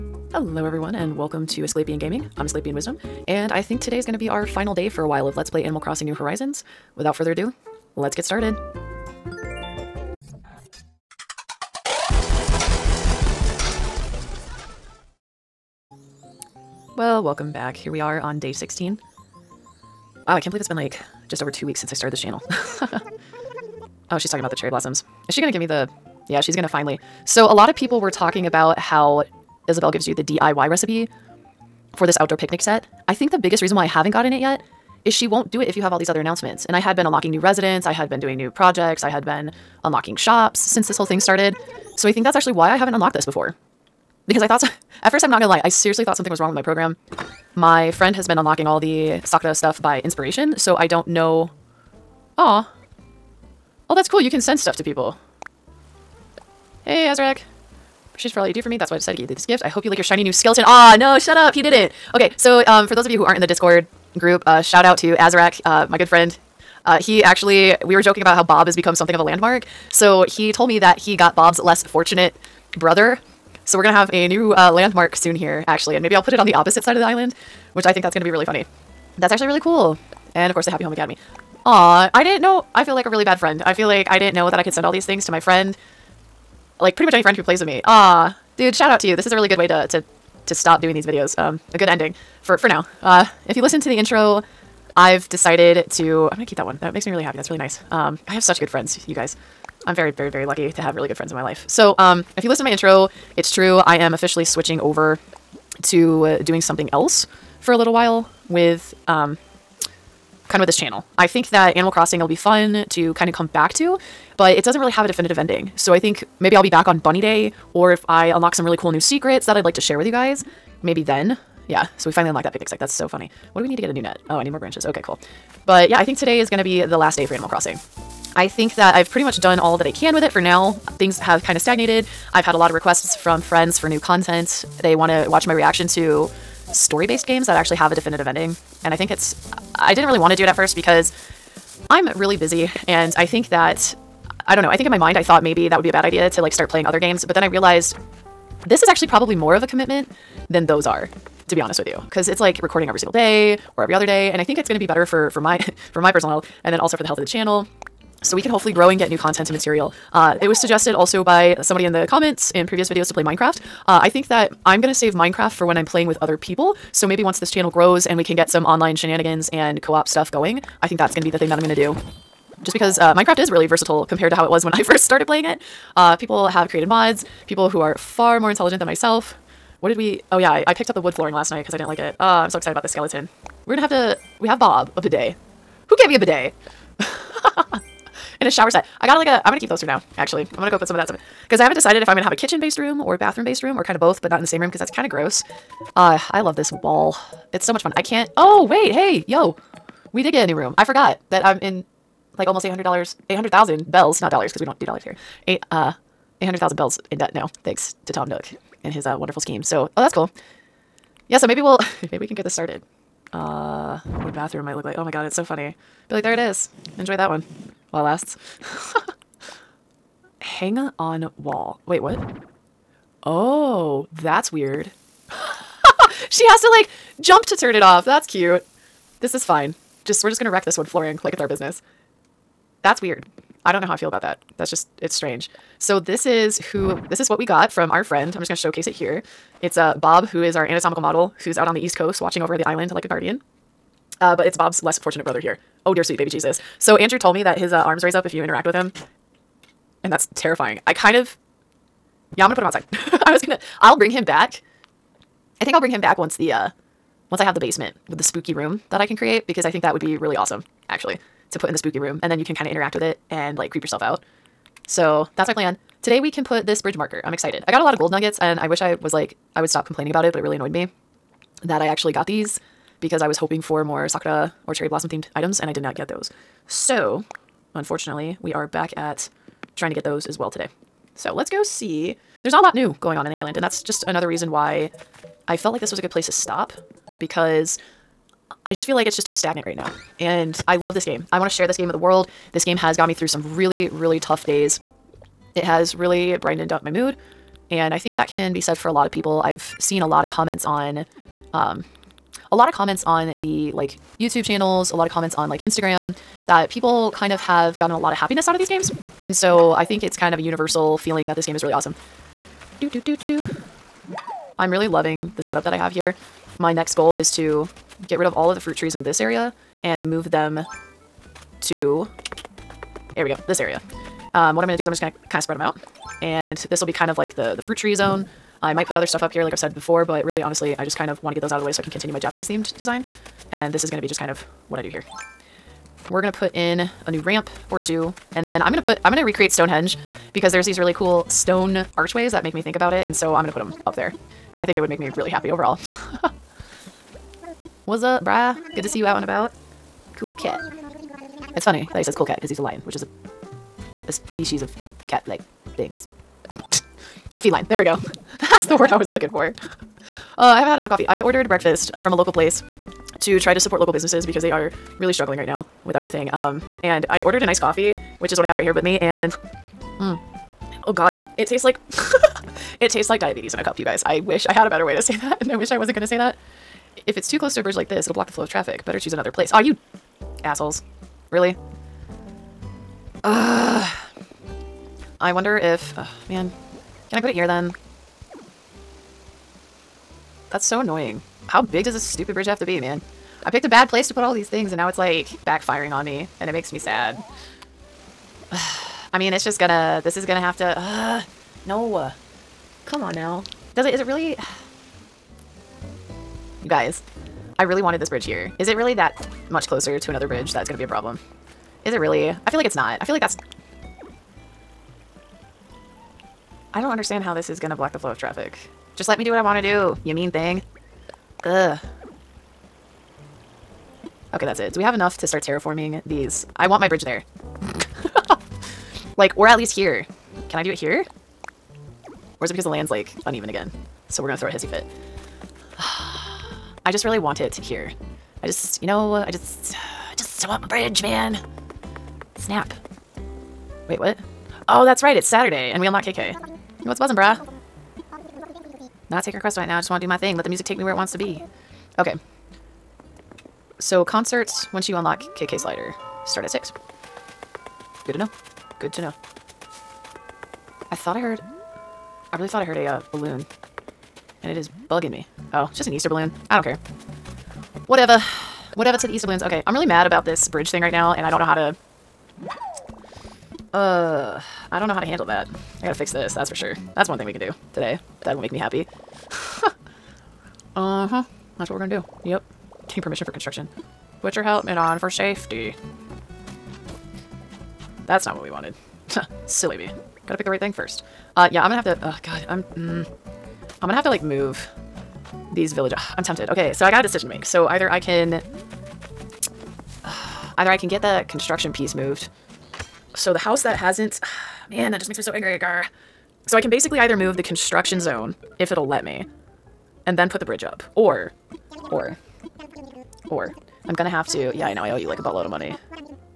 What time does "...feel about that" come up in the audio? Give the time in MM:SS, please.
03:53.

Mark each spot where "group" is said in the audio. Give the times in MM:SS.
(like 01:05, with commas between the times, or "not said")
01:04.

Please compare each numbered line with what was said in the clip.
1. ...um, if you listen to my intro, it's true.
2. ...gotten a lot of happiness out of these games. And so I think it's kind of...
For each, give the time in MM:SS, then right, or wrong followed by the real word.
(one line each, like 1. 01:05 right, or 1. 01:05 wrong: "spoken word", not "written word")
1. 01:41 right
2. 05:07 right.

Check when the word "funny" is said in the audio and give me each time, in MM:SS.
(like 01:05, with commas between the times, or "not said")
01:18, 02:03, 03:35, 05:51.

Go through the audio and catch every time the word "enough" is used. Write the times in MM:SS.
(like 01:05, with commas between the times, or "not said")
06:00, 07:04.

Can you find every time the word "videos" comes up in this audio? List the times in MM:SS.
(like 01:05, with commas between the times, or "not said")
01:31, 02:42.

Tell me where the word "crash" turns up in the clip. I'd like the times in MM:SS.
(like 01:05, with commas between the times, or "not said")
not said.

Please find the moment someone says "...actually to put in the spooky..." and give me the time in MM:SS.
04:20.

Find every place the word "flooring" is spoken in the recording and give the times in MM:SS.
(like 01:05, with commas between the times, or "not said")
03:01, 03:50.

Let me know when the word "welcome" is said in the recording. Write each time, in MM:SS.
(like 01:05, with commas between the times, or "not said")
00:01, 00:17.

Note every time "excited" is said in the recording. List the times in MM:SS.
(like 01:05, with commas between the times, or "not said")
03:02, 04:27.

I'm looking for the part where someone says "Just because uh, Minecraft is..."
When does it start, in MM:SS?
02:52.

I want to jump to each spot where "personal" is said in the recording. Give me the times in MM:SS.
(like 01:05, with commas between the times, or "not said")
02:36.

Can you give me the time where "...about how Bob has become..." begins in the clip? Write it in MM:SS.
01:08.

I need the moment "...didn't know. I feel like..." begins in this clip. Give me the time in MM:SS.
01:22.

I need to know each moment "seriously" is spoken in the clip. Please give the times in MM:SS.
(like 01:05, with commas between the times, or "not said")
00:45.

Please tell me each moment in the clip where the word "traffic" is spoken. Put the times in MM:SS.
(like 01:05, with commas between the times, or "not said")
06:18, 06:58.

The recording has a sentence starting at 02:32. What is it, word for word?
Cause it's like recording every single day or every other day.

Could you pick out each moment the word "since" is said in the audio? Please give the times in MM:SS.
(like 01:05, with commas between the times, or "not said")
00:21, 00:40.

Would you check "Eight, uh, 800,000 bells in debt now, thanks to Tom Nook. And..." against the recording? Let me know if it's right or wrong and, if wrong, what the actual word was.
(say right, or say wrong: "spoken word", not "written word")
right.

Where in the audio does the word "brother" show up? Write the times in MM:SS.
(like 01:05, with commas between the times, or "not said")
01:12, 04:05.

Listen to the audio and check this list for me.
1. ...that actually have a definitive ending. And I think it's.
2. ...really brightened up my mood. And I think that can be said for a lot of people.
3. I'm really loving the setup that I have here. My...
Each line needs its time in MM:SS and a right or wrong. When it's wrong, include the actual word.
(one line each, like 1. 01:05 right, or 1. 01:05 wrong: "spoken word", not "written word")
1. 02:17 right
2. 04:55 right
3. 05:14 right.